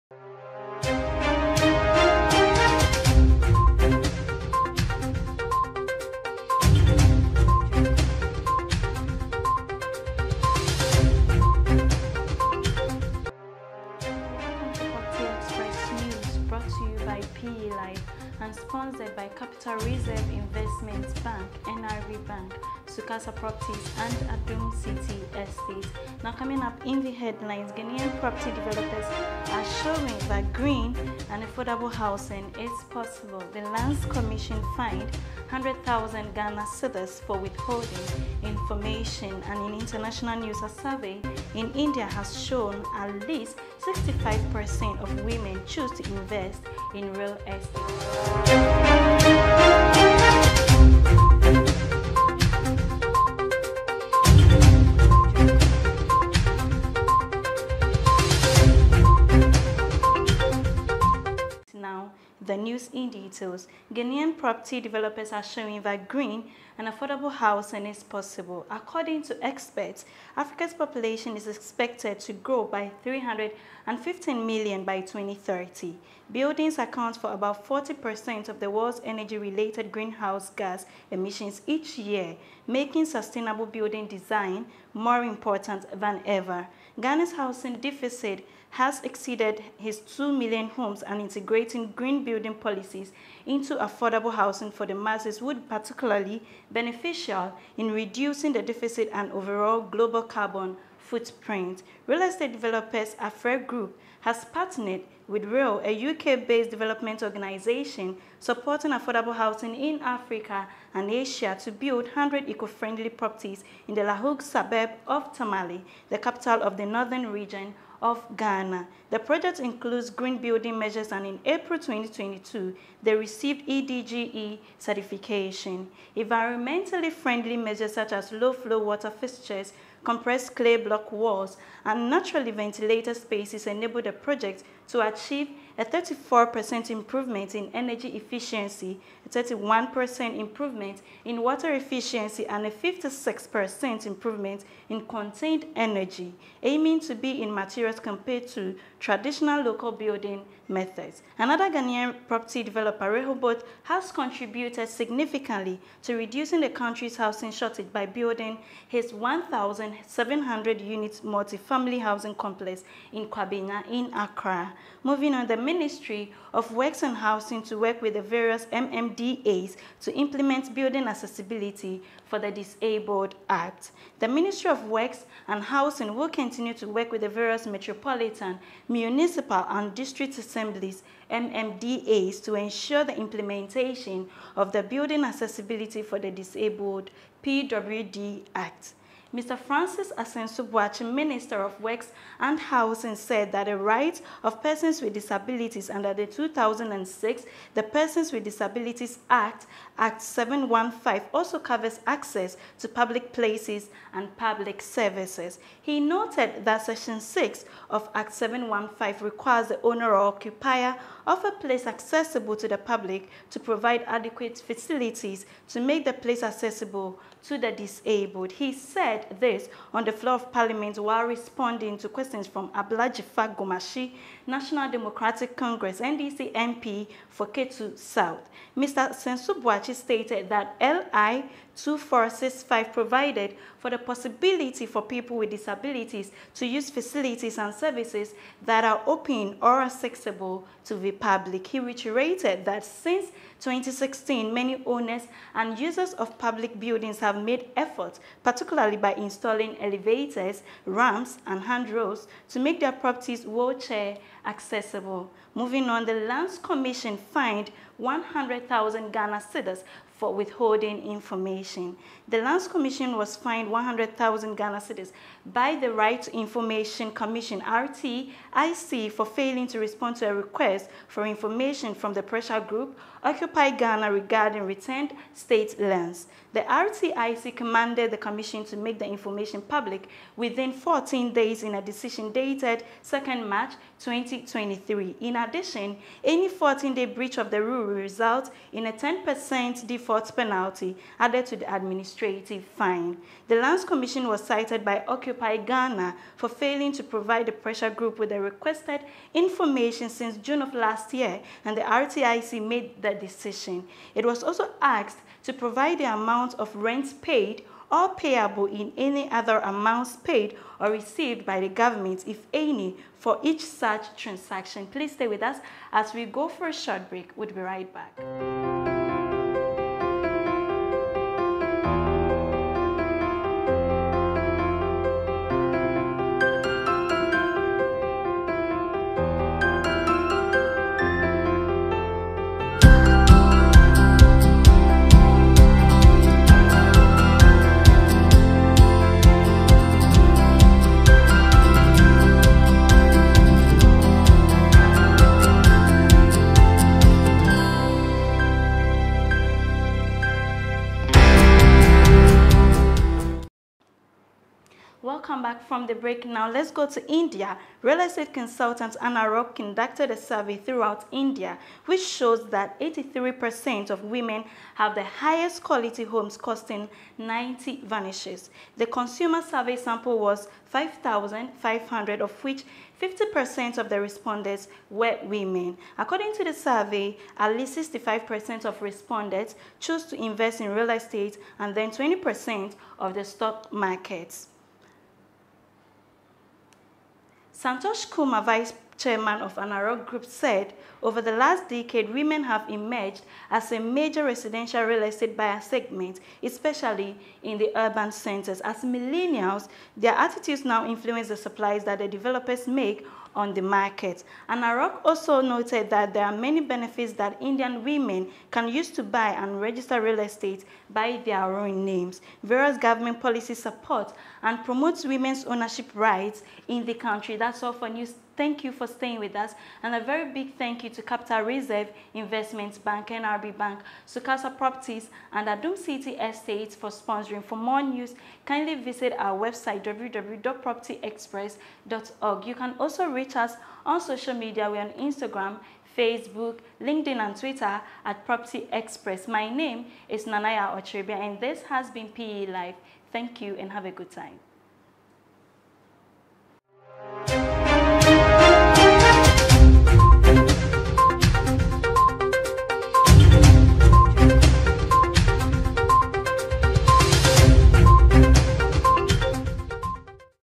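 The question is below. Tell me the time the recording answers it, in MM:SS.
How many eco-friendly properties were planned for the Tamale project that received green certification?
01:52.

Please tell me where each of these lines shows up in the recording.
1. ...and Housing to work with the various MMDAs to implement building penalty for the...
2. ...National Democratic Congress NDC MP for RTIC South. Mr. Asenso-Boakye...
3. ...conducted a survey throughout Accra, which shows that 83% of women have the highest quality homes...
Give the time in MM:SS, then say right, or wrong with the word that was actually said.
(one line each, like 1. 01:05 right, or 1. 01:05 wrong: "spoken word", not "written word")
1. 02:47 wrong: "accessibility", not "penalty"
2. 03:44 wrong: "Ketu", not "RTIC"
3. 05:59 wrong: "India", not "Accra".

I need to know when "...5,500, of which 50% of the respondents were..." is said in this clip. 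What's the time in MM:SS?
06:10.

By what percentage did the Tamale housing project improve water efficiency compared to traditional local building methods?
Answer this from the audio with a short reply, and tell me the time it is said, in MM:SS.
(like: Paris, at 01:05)
31%, at 02:19.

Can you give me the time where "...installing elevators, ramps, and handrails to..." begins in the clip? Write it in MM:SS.
04:09.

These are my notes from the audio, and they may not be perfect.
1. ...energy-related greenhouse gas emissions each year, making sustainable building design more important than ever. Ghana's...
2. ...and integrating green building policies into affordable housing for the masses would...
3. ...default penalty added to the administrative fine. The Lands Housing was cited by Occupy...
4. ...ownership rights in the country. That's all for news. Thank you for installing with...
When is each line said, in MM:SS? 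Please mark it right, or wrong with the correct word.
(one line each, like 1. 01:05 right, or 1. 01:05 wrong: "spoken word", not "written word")
1. 01:19 right
2. 01:31 right
3. 04:49 wrong: "Commission", not "Housing"
4. 06:55 wrong: "staying", not "installing".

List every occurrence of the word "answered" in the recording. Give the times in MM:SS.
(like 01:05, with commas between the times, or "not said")
not said.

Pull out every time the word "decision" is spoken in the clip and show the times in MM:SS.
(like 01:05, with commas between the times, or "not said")
04:41, 05:03.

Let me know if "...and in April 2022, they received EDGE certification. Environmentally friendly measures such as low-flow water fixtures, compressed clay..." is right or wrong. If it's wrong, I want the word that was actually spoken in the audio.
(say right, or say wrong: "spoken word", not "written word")
right.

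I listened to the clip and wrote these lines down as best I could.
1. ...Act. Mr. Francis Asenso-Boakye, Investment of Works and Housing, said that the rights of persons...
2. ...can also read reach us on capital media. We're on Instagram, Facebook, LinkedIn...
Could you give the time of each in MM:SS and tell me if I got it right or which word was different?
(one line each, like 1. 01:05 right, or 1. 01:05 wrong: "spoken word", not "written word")
1. 03:08 wrong: "Minister", not "Investment"
2. 07:12 wrong: "social", not "capital".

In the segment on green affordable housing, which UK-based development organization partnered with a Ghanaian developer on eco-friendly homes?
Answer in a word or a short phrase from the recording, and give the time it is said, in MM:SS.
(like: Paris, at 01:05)
Reall, at 01:45.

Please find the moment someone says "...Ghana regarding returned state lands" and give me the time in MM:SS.
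04:33.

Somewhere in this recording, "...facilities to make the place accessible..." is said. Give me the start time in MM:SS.
03:34.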